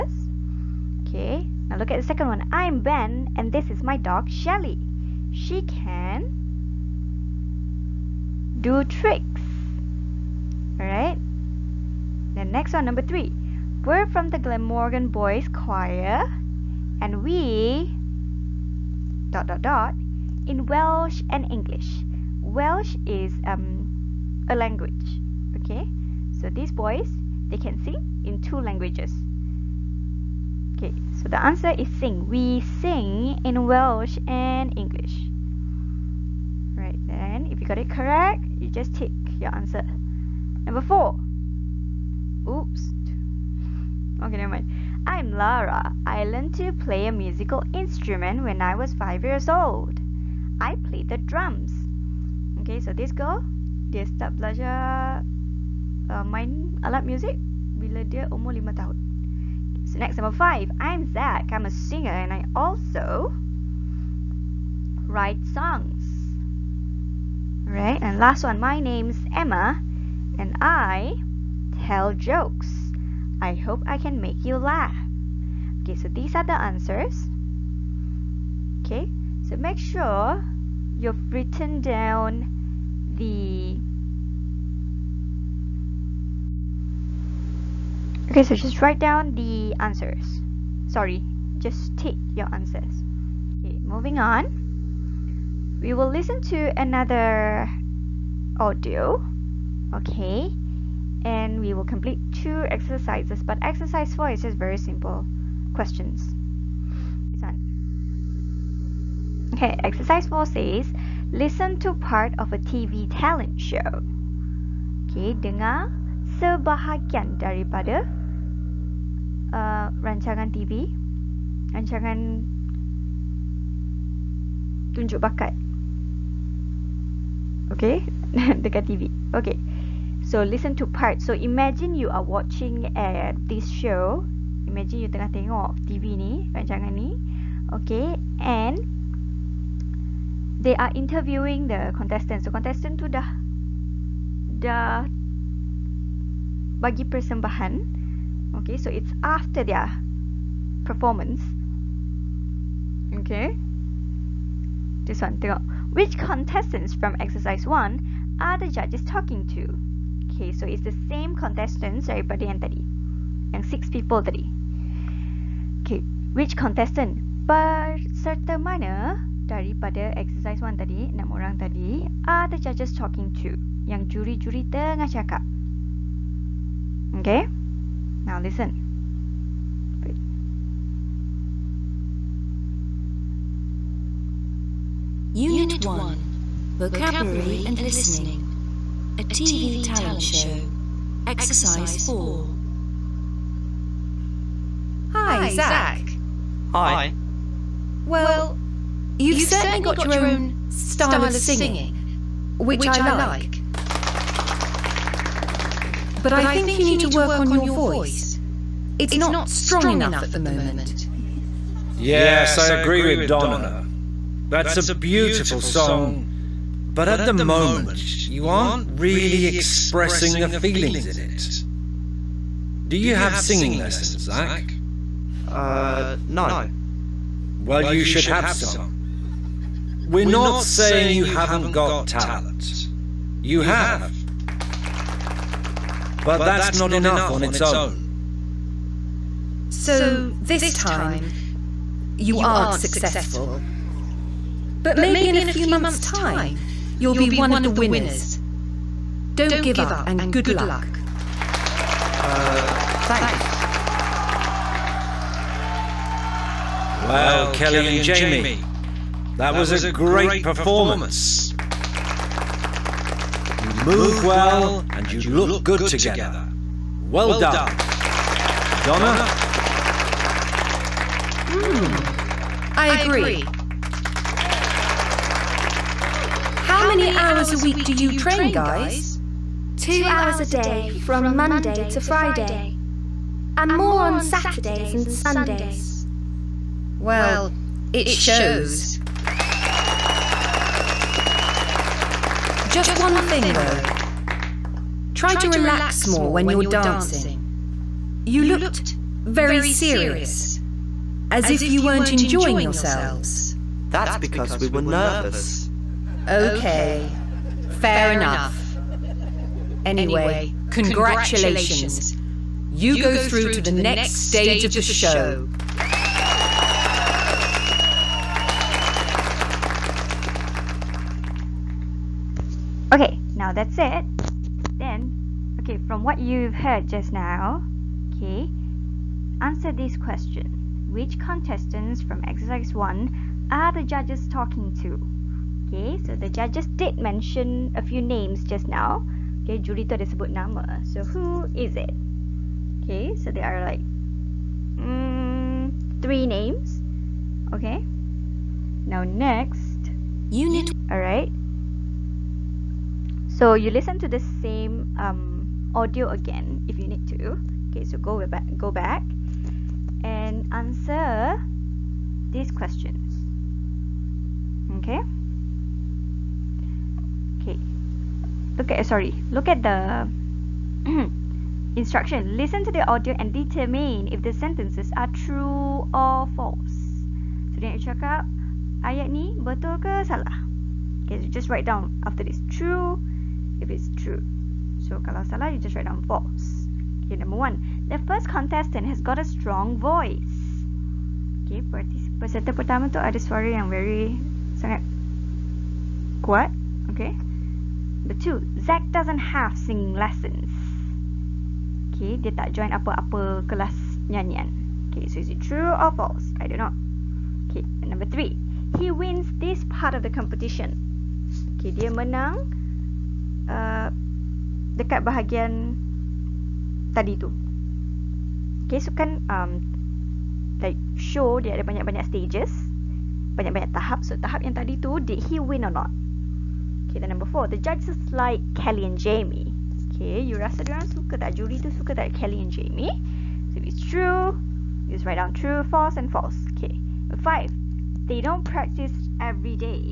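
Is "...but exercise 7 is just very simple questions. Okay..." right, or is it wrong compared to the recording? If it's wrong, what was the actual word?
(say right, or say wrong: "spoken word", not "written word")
wrong: "4", not "7".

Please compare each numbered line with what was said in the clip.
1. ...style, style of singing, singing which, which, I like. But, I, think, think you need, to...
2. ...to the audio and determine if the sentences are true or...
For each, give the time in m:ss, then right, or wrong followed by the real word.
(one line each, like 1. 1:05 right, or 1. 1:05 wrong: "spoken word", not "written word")
1. 3:20 right
2. 6:12 right.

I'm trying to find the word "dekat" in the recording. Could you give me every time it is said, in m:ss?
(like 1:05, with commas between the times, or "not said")
2:08, 6:54.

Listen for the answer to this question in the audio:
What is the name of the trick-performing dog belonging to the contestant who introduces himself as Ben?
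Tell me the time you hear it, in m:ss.
0:04.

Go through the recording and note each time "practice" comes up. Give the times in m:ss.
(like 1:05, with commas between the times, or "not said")
7:18.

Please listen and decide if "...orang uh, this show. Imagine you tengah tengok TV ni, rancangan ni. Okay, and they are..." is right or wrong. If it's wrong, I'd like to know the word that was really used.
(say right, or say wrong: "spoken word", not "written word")
wrong: "watching", not "orang".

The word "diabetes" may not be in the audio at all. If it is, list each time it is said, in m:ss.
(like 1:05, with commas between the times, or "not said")
not said.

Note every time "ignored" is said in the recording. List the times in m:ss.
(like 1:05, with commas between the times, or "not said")
not said.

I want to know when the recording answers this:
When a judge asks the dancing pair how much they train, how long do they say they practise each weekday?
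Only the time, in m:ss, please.
4:39.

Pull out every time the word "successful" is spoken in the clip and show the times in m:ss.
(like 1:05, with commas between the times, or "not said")
4:02.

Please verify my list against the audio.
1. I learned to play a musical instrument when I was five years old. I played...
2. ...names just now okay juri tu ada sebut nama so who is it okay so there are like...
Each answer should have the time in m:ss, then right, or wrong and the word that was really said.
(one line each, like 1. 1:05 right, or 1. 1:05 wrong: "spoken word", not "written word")
1. 0:46 right
2. 5:37 right.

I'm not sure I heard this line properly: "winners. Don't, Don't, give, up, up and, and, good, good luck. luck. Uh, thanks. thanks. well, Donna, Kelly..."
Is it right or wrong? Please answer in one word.
wrong.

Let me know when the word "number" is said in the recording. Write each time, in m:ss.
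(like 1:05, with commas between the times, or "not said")
0:12, 0:40, 1:00, 6:27, 6:38, 6:47, 7:07, 7:17.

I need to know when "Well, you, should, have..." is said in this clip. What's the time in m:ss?
3:47.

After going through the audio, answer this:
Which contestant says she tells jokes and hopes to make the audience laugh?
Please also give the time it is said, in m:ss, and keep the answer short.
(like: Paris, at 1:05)
Emma, at 1:09.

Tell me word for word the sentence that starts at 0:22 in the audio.
Welsh is um, a language, okay?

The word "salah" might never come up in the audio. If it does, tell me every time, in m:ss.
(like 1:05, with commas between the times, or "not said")
6:20, 6:25.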